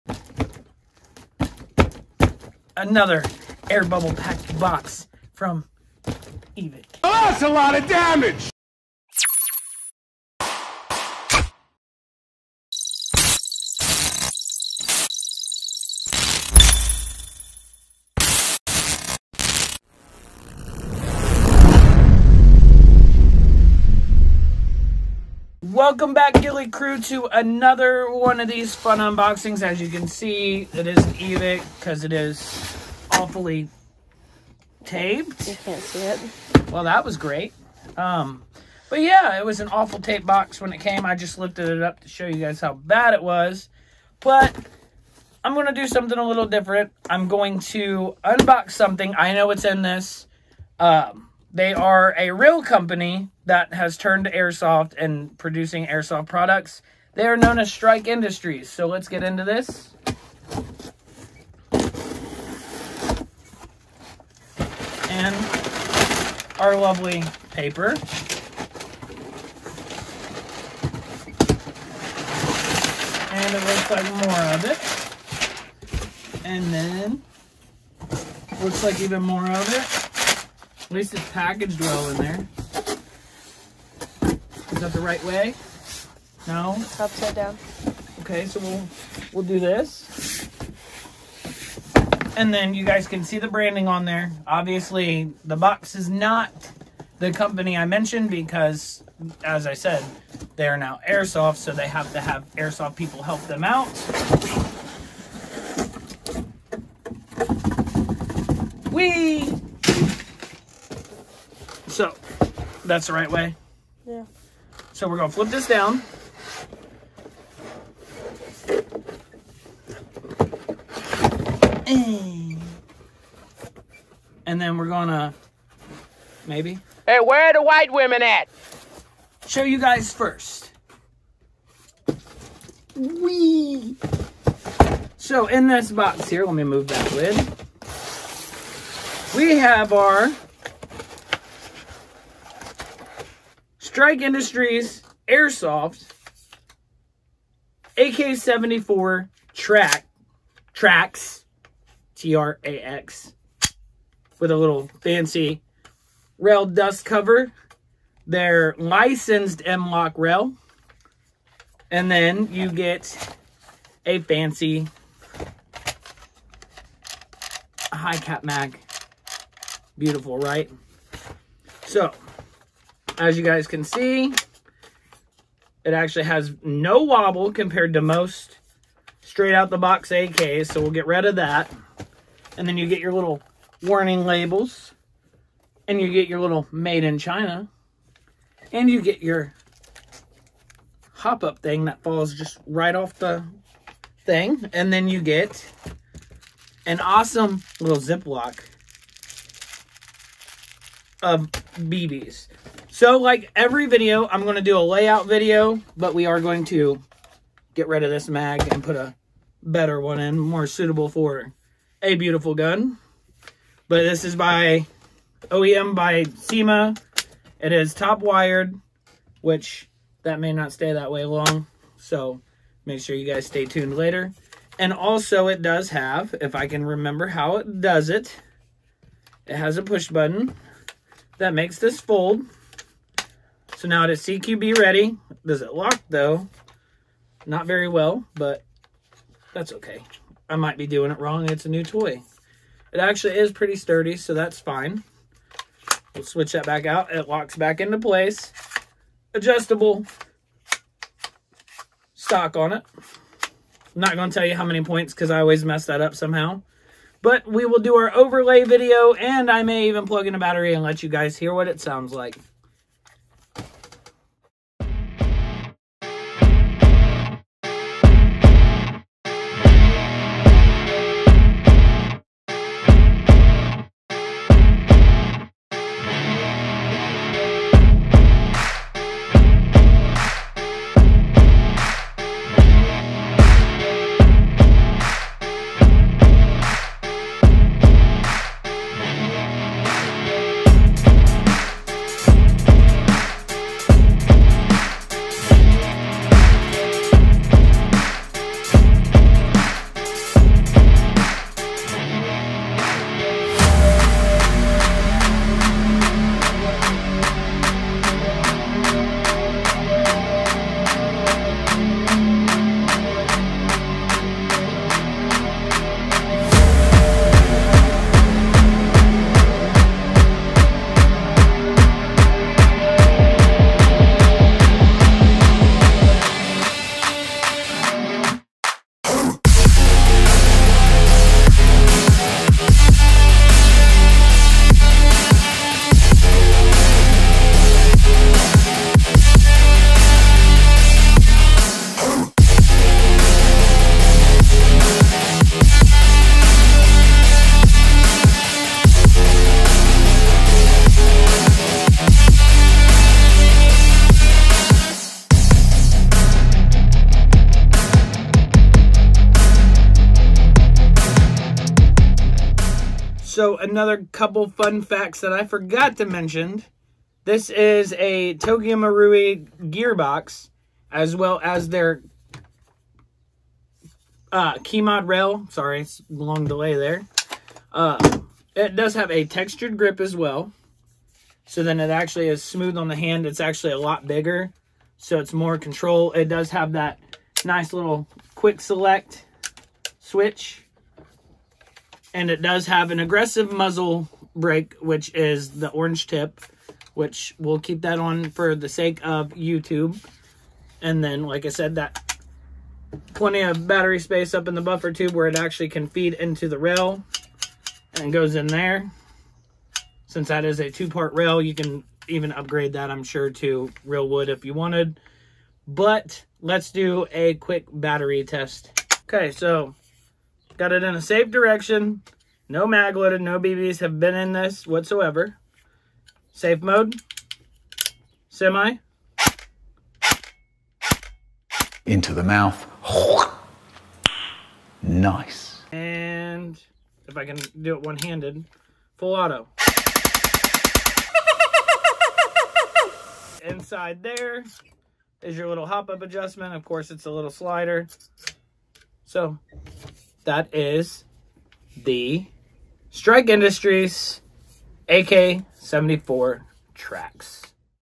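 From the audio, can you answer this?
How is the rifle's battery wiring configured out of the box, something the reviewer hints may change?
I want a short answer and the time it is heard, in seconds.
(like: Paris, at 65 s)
Top wired, at 217 s.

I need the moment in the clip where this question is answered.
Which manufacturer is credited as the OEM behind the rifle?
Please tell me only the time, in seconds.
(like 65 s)
216 s.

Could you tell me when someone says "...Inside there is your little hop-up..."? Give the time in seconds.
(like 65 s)
443 s.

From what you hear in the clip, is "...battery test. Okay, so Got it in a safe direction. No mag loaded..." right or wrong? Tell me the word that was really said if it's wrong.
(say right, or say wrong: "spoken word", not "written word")
right.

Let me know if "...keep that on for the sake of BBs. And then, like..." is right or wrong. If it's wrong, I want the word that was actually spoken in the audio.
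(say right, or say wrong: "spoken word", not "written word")
wrong: "YouTube", not "BBs".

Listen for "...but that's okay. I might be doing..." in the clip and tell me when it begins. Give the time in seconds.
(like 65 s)
238 s.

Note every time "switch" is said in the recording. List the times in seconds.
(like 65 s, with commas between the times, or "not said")
246 s, 389 s.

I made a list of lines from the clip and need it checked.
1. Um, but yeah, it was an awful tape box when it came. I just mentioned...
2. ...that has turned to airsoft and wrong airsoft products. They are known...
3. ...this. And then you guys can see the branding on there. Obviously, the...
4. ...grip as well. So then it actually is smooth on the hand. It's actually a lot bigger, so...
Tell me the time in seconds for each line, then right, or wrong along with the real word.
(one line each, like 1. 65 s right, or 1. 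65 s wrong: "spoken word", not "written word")
1. 37 s wrong: "lifted", not "mentioned"
2. 53 s wrong: "producing", not "wrong"
3. 89 s right
4. 379 s right.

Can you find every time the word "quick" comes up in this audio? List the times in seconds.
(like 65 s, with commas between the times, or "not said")
388 s, 417 s.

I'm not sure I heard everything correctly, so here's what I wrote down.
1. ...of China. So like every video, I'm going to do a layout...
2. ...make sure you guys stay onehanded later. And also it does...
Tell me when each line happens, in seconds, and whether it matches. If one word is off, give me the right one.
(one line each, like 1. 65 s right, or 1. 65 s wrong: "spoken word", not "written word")
1. 201 s wrong: "BBs", not "China"
2. 222 s wrong: "tuned", not "onehanded".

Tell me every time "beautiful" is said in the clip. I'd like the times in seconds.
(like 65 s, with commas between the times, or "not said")
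169 s, 212 s.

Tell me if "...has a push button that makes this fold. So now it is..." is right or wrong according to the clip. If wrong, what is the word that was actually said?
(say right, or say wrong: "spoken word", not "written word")
right.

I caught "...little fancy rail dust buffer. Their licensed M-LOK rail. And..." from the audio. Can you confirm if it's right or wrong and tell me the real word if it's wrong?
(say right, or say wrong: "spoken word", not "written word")
wrong: "cover", not "buffer".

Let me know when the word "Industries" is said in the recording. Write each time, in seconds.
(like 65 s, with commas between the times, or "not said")
58 s, 144 s, 453 s.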